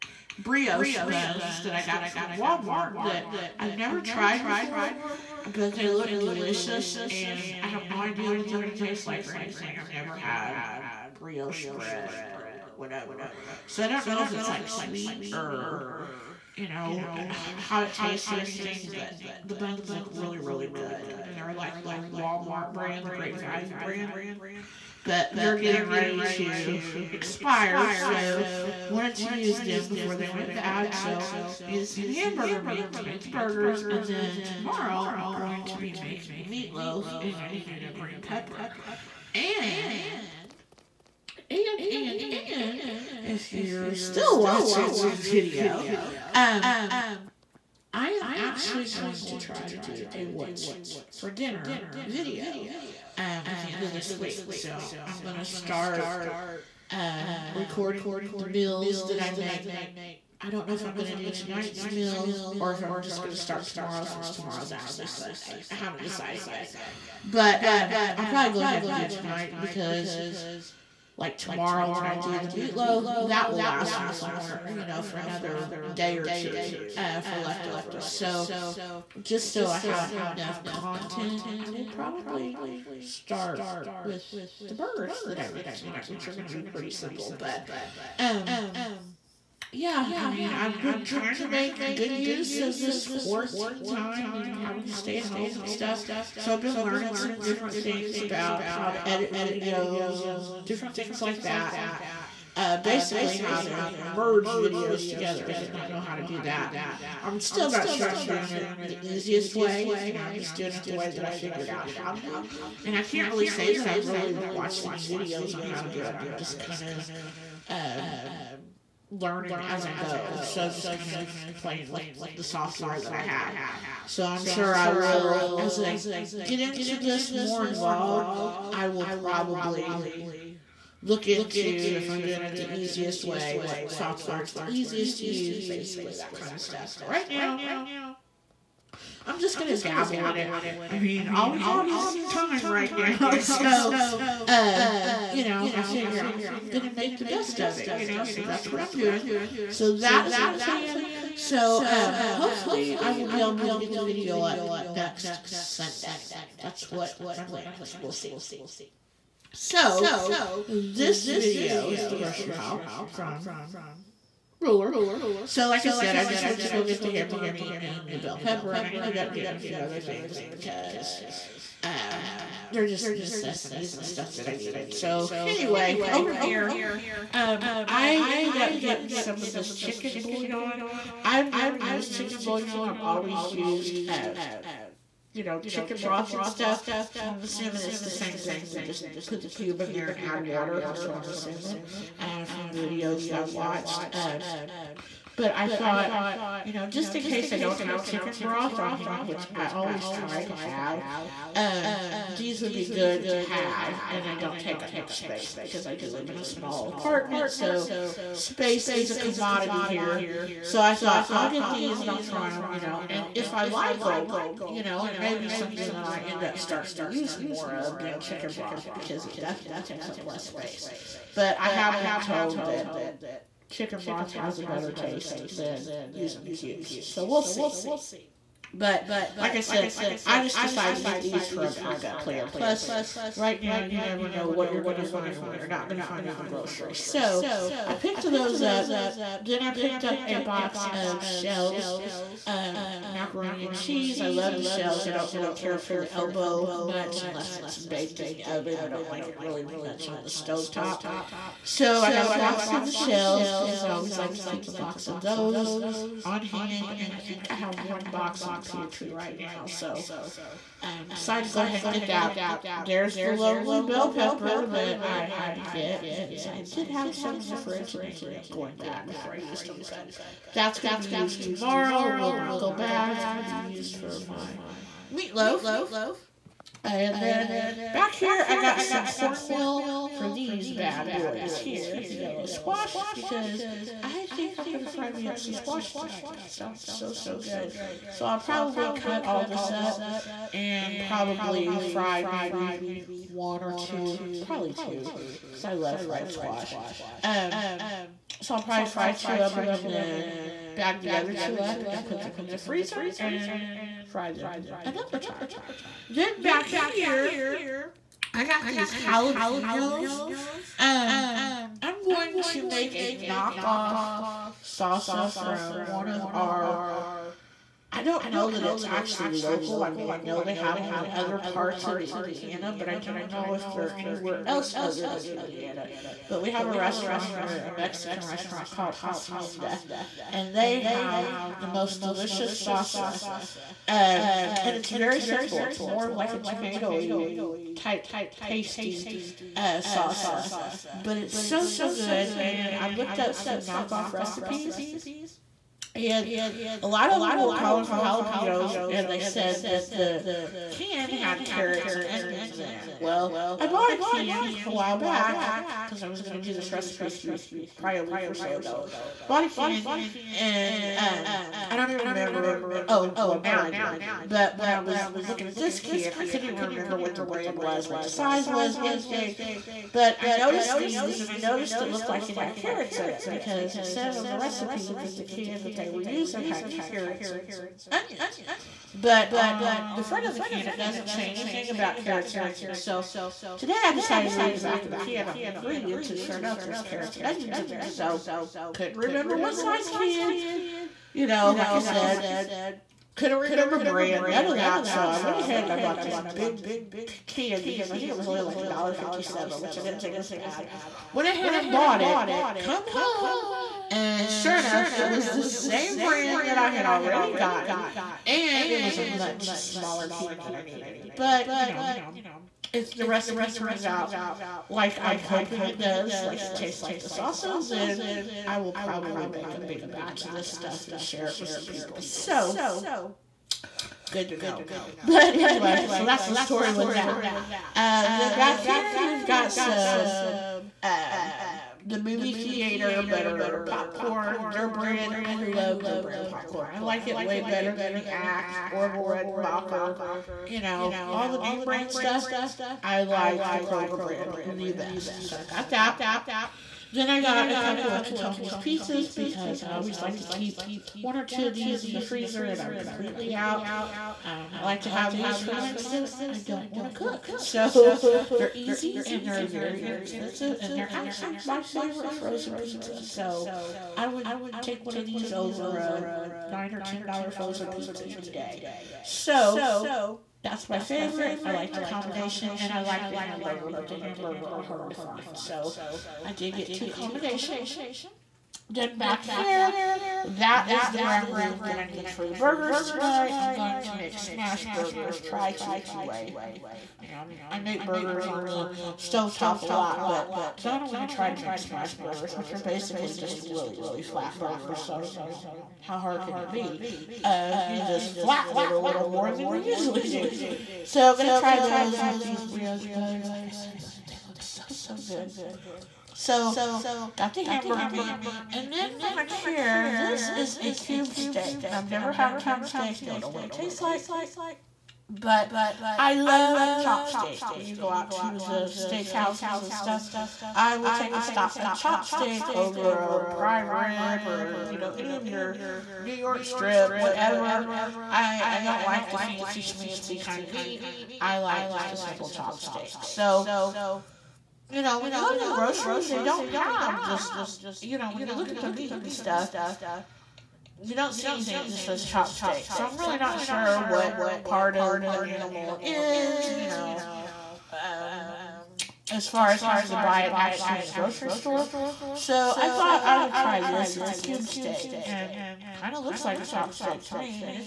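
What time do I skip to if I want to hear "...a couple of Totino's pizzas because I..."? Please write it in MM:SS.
07:27.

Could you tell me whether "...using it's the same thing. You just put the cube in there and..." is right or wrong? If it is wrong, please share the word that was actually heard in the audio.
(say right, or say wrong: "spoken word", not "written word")
wrong: "assuming", not "using".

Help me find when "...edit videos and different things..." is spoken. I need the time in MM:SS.
01:39.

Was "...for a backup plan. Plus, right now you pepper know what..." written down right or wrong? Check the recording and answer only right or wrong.
wrong.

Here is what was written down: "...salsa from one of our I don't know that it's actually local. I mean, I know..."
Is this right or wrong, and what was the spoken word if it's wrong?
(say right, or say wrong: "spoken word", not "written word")
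right.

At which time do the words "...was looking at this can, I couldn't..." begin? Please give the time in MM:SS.
06:04.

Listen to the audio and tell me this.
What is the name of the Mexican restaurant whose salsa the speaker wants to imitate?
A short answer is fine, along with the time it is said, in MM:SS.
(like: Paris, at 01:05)
Hacienda, at 05:28.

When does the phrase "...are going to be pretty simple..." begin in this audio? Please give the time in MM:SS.
01:26.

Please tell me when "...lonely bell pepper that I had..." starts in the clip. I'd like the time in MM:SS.
04:23.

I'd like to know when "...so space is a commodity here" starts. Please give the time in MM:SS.
03:27.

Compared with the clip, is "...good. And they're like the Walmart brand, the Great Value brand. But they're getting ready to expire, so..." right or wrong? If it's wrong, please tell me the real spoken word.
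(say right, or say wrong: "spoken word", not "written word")
right.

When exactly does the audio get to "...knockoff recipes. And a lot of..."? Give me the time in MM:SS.
05:43.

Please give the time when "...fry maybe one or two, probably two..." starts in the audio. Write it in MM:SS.
04:51.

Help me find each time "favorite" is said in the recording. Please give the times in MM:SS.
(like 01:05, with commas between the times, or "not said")
07:41, 07:50.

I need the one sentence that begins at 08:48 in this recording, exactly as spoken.
I, I don't like the fancy schmancy kind of meat.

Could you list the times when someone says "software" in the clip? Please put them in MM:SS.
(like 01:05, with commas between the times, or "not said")
02:02, 02:13.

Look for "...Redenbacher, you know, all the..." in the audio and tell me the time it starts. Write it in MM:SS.
07:19.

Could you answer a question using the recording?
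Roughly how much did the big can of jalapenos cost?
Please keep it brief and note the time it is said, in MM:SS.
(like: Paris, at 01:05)
$1.57, at 06:38.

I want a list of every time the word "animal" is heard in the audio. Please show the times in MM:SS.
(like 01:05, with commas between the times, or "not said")
09:05.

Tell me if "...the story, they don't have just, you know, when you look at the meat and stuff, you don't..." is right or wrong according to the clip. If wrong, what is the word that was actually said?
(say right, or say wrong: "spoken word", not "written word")
wrong: "grocery", not "story".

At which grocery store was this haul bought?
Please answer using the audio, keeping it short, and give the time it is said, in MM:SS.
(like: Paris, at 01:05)
Ruler, at 02:44.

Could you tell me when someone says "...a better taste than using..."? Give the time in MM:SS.
03:44.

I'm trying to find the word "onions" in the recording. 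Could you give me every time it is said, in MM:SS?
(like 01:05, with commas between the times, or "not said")
05:52, 06:17, 06:22, 06:27.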